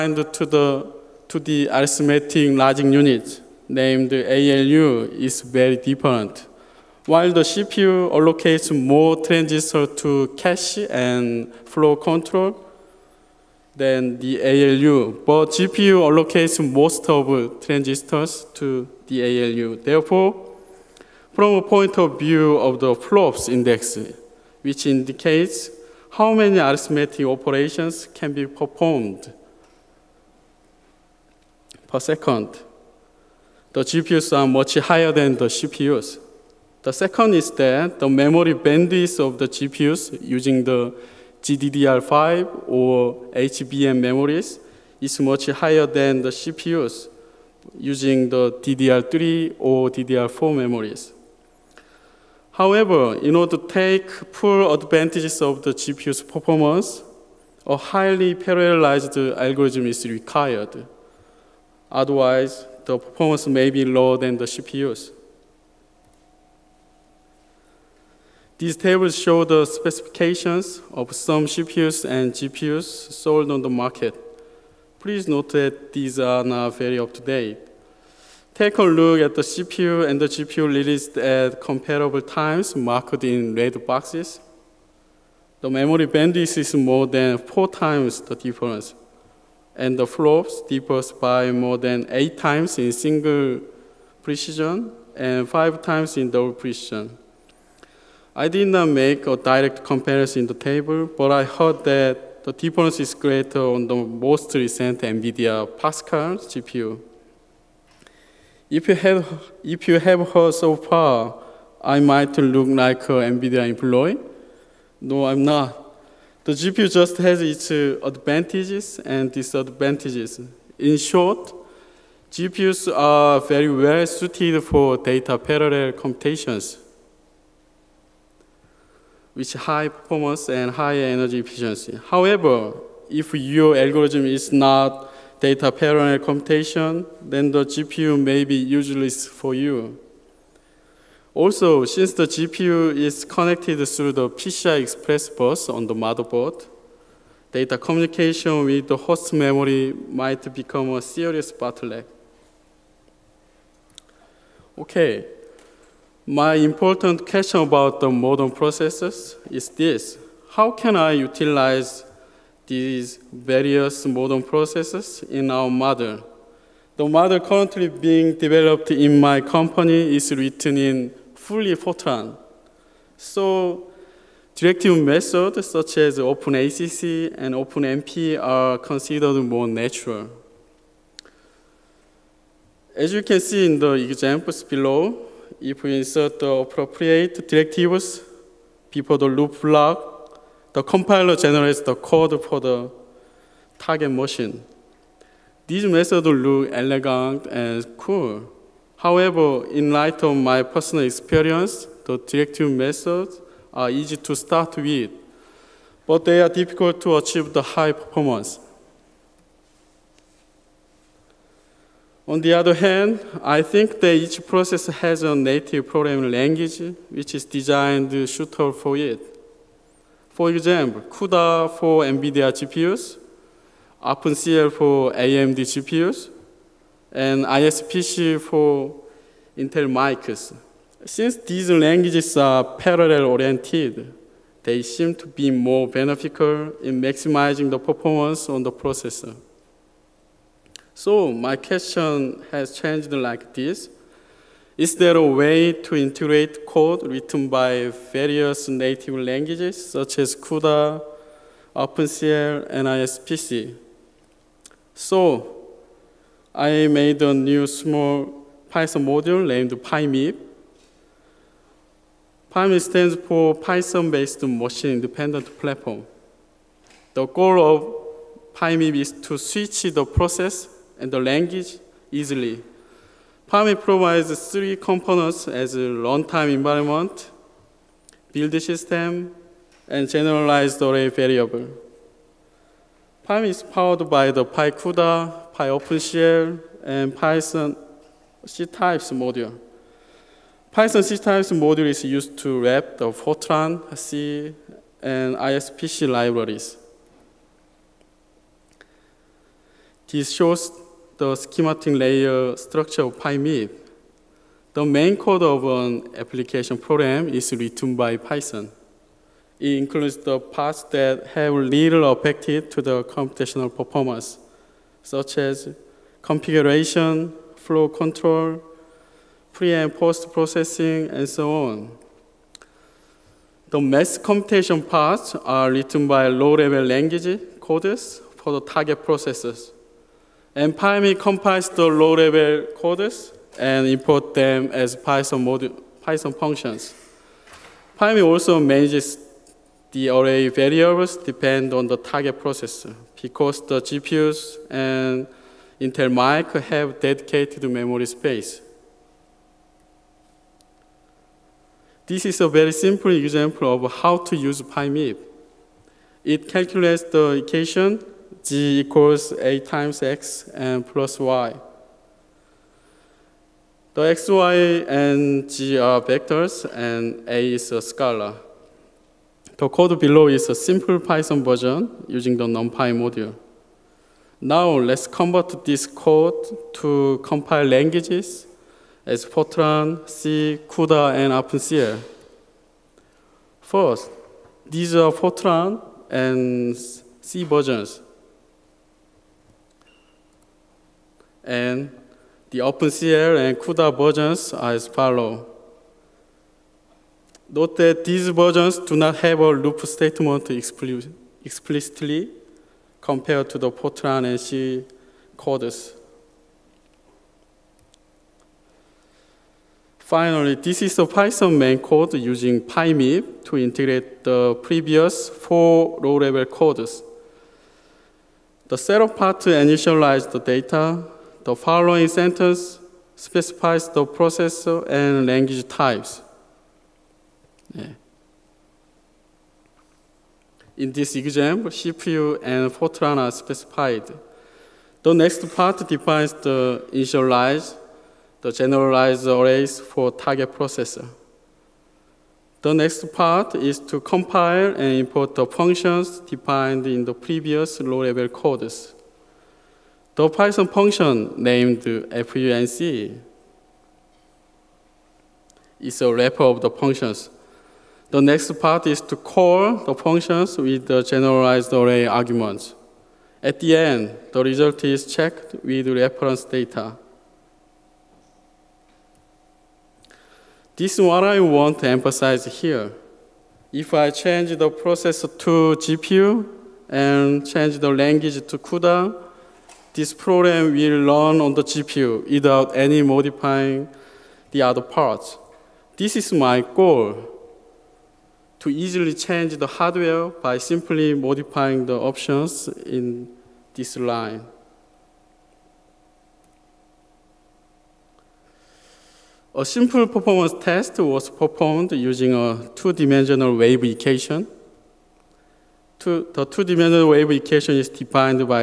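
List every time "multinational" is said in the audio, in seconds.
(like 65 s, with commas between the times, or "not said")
not said.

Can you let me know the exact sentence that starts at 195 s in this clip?
These methods look elegant and cool.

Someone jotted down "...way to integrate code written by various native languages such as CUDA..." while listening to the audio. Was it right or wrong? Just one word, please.
right.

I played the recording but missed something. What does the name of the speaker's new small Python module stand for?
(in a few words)
Python-based machine-independent platform.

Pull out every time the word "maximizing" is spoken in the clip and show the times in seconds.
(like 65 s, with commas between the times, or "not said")
237 s.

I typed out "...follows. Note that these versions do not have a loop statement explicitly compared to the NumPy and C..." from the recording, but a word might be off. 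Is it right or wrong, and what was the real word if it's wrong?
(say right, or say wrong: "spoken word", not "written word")
wrong: "Fortran", not "NumPy".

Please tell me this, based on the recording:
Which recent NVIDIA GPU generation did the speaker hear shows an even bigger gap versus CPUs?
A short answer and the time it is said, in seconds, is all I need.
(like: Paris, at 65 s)
Pascal, at 105 s.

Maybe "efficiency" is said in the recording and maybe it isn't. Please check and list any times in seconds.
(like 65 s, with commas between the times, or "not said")
131 s.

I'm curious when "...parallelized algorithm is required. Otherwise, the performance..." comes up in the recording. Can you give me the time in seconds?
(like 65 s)
58 s.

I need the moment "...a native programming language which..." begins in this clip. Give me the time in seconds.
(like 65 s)
215 s.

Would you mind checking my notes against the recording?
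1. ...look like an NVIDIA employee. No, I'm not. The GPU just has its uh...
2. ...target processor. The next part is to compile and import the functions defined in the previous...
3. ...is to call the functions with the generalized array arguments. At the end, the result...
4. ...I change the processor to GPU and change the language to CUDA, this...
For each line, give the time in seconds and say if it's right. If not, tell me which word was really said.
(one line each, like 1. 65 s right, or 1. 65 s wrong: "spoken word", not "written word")
1. 112 s right
2. 440 s right
3. 458 s right
4. 473 s right.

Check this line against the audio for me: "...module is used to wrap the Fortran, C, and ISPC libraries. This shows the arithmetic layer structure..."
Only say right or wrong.
wrong.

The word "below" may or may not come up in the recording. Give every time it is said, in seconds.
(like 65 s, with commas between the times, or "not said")
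184 s, 369 s.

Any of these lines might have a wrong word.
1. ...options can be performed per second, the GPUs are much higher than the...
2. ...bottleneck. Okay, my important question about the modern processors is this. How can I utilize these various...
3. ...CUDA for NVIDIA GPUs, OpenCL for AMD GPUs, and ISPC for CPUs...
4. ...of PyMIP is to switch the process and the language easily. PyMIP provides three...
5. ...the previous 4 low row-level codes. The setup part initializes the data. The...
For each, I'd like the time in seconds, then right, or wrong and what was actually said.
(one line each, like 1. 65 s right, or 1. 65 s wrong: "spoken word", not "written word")
1. 27 s wrong: "operations", not "options"
2. 151 s right
3. 221 s wrong: "Intel", not "CPUs"
4. 267 s right
5. 414 s right.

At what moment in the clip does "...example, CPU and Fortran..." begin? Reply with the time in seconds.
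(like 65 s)
431 s.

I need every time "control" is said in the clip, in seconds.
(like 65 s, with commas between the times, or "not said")
11 s, 317 s.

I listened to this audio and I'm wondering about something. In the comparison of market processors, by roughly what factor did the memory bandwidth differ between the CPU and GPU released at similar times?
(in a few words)
more than 4 times.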